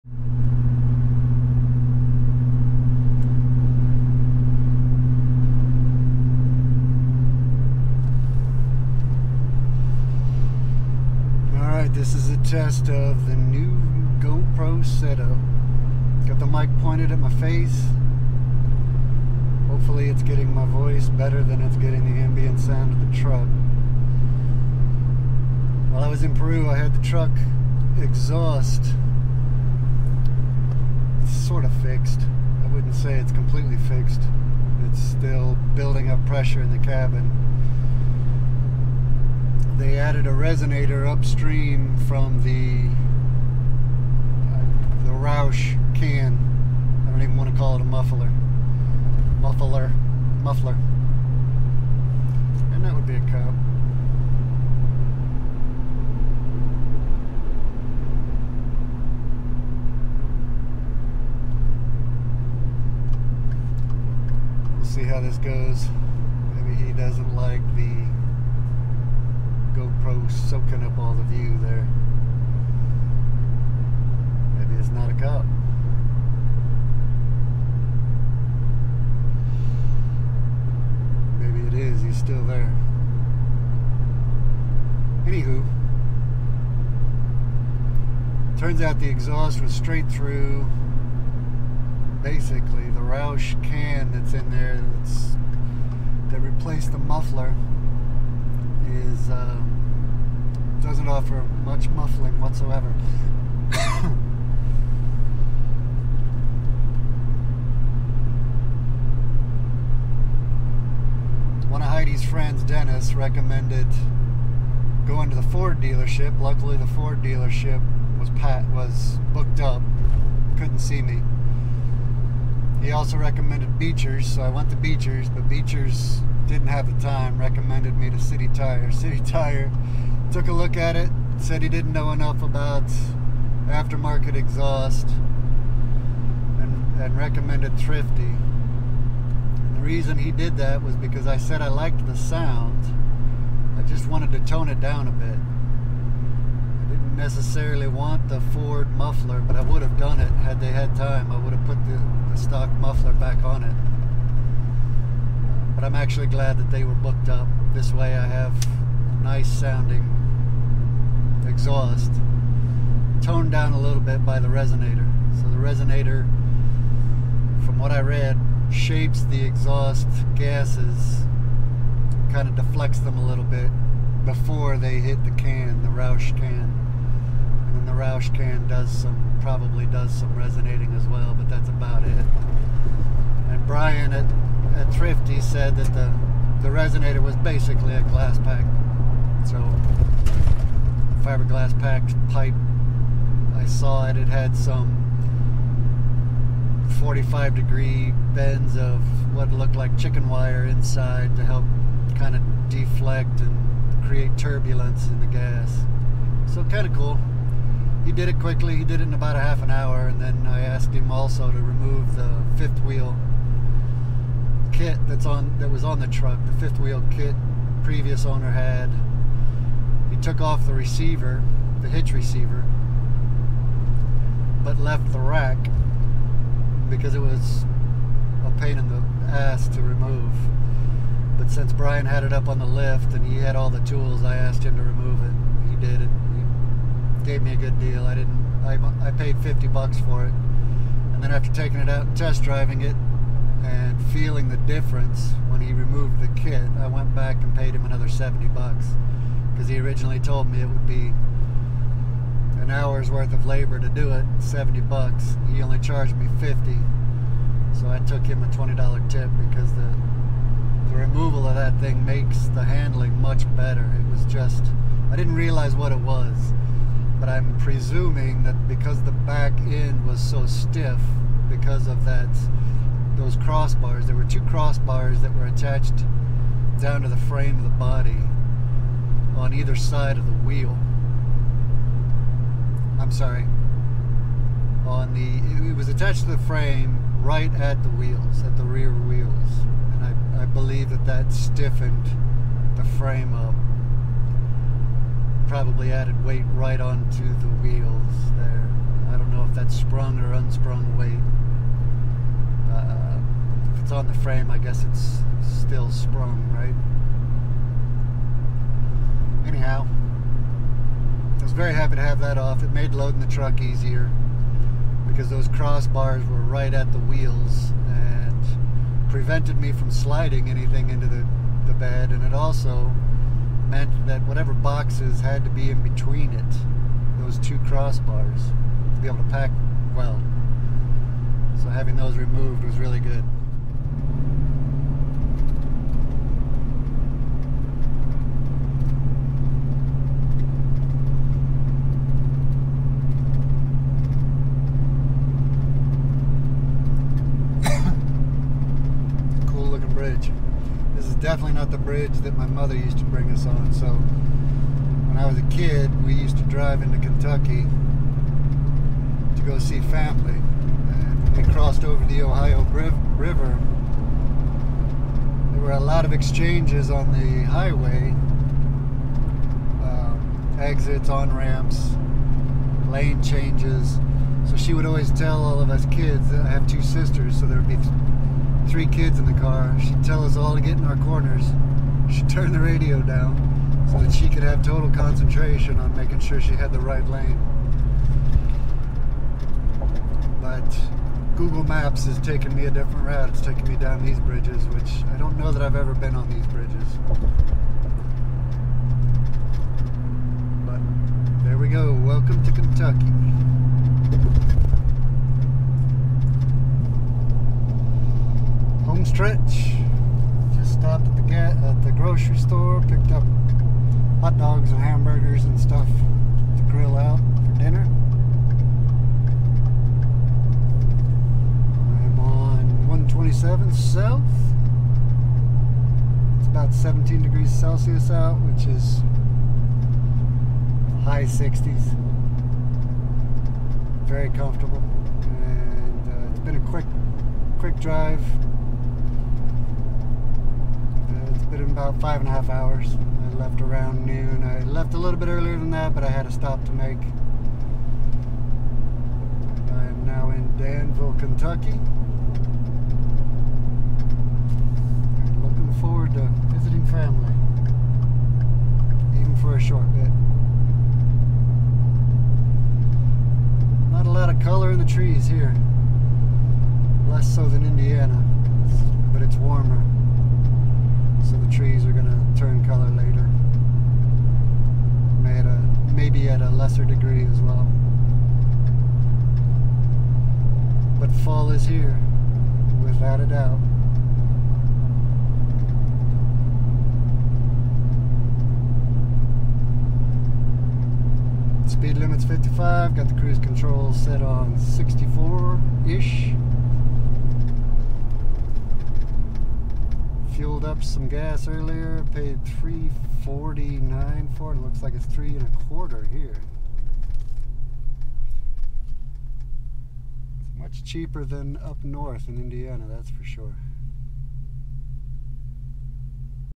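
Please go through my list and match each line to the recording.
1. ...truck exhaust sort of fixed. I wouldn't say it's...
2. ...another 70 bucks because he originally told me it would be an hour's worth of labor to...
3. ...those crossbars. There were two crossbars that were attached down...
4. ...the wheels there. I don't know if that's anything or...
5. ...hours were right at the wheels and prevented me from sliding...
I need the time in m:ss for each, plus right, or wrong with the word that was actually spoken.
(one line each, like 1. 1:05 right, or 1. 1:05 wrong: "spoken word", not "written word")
1. 0:27 right
2. 4:07 right
3. 4:33 right
4. 4:57 wrong: "sprung", not "anything"
5. 5:15 wrong: "crossbars", not "hours".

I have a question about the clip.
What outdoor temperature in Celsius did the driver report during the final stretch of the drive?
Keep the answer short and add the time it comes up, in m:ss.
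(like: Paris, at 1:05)
17, at 7:06.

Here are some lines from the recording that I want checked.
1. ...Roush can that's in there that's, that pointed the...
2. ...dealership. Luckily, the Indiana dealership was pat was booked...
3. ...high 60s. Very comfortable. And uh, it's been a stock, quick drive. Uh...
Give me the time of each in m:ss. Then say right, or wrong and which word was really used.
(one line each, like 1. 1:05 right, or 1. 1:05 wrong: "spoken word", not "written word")
1. 1:32 wrong: "replaced", not "pointed"
2. 1:55 wrong: "Ford", not "Indiana"
3. 7:11 wrong: "quick", not "stock".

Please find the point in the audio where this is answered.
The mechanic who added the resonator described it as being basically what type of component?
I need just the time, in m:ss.
3:07.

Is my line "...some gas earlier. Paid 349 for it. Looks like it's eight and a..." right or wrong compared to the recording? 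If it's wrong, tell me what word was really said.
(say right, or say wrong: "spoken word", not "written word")
wrong: "three", not "eight".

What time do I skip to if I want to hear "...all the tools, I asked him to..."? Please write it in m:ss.
3:53.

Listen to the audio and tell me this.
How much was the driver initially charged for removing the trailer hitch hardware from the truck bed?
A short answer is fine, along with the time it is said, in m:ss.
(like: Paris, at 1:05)
$50, at 3:59.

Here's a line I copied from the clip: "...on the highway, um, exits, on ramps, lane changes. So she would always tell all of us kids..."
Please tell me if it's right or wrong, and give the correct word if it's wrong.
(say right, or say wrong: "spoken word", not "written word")
right.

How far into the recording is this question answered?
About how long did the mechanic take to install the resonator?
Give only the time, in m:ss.
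3:29.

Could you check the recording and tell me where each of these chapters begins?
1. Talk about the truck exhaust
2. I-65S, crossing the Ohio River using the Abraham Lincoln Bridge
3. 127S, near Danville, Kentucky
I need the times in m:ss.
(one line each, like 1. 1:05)
1. 0:20
2. 5:33
3. 6:45.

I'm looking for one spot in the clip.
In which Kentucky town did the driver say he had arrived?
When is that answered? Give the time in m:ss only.
7:30.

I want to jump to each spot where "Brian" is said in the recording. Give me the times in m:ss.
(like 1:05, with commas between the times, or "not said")
3:03, 3:51.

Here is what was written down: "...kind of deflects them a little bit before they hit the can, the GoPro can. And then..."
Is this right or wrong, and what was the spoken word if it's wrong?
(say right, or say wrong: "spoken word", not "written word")
wrong: "Roush", not "GoPro".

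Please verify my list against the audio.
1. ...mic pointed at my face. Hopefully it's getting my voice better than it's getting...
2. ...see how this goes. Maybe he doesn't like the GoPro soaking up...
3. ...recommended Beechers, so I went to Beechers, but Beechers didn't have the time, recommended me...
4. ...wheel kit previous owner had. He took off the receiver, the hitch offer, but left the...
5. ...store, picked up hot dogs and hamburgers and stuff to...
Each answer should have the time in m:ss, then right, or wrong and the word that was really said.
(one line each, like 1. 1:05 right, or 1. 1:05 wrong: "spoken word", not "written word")
1. 0:16 right
2. 1:04 right
3. 2:03 right
4. 3:36 wrong: "receiver", not "offer"
5. 6:52 right.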